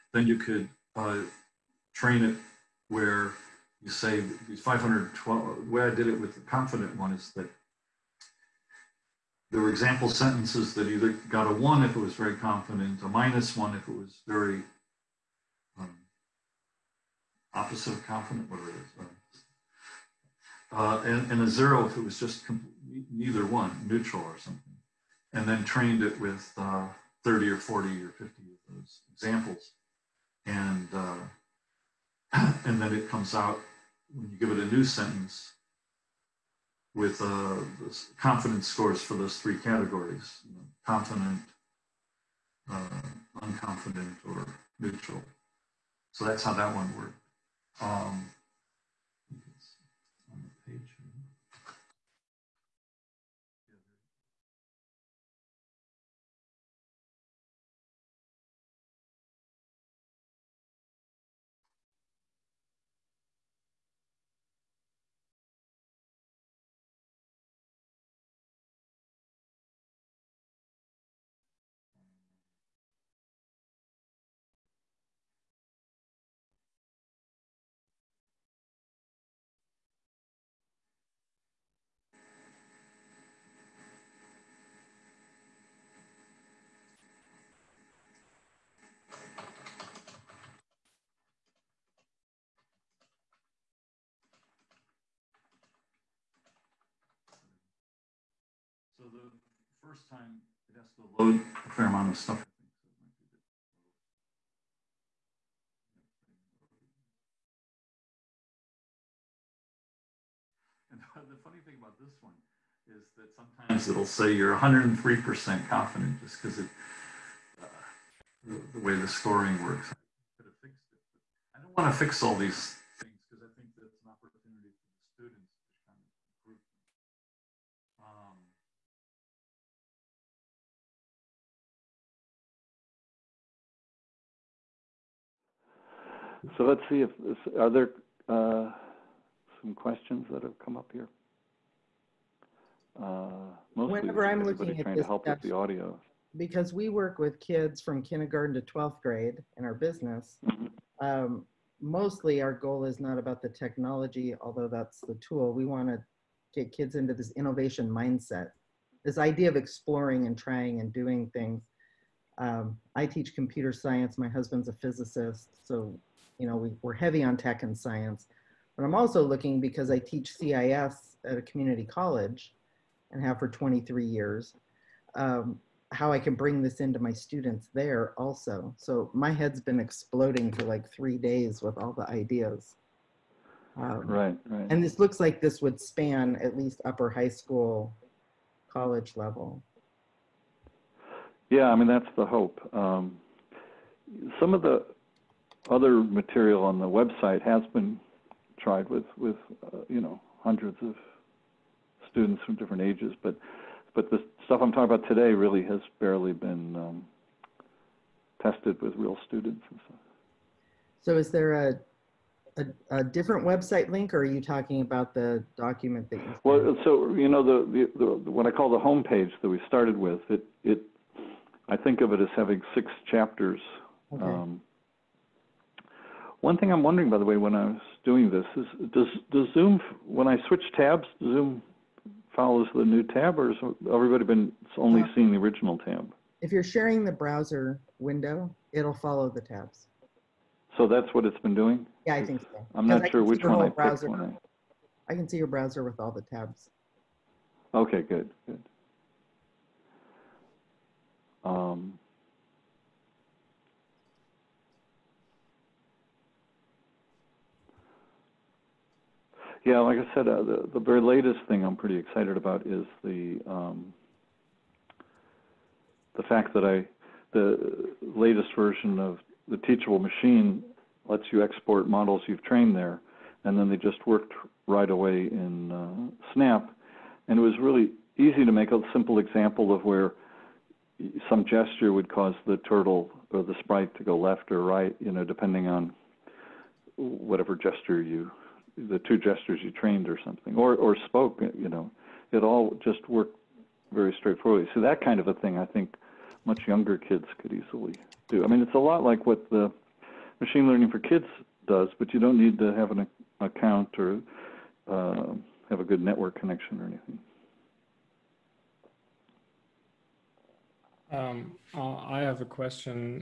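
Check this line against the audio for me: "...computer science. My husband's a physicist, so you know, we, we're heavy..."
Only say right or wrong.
right.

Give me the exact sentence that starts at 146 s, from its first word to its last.
Because we work with kids from kindergarten to 12th grade in our business.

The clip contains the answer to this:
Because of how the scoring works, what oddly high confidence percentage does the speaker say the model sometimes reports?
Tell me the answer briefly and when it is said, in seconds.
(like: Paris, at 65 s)
103%, at 114 s.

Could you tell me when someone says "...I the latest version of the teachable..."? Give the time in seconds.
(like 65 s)
266 s.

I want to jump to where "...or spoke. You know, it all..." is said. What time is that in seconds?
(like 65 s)
290 s.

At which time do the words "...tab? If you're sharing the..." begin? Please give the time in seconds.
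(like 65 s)
235 s.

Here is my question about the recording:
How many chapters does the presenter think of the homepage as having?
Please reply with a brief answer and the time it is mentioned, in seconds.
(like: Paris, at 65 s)
6, at 222 s.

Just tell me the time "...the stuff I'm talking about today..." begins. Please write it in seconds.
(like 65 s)
204 s.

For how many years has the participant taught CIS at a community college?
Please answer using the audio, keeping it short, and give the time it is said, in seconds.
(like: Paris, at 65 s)
23, at 173 s.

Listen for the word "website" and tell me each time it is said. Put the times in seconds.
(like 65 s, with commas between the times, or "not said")
196 s, 213 s.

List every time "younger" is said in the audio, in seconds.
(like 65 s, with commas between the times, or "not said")
296 s.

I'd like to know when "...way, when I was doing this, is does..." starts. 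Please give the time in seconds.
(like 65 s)
227 s.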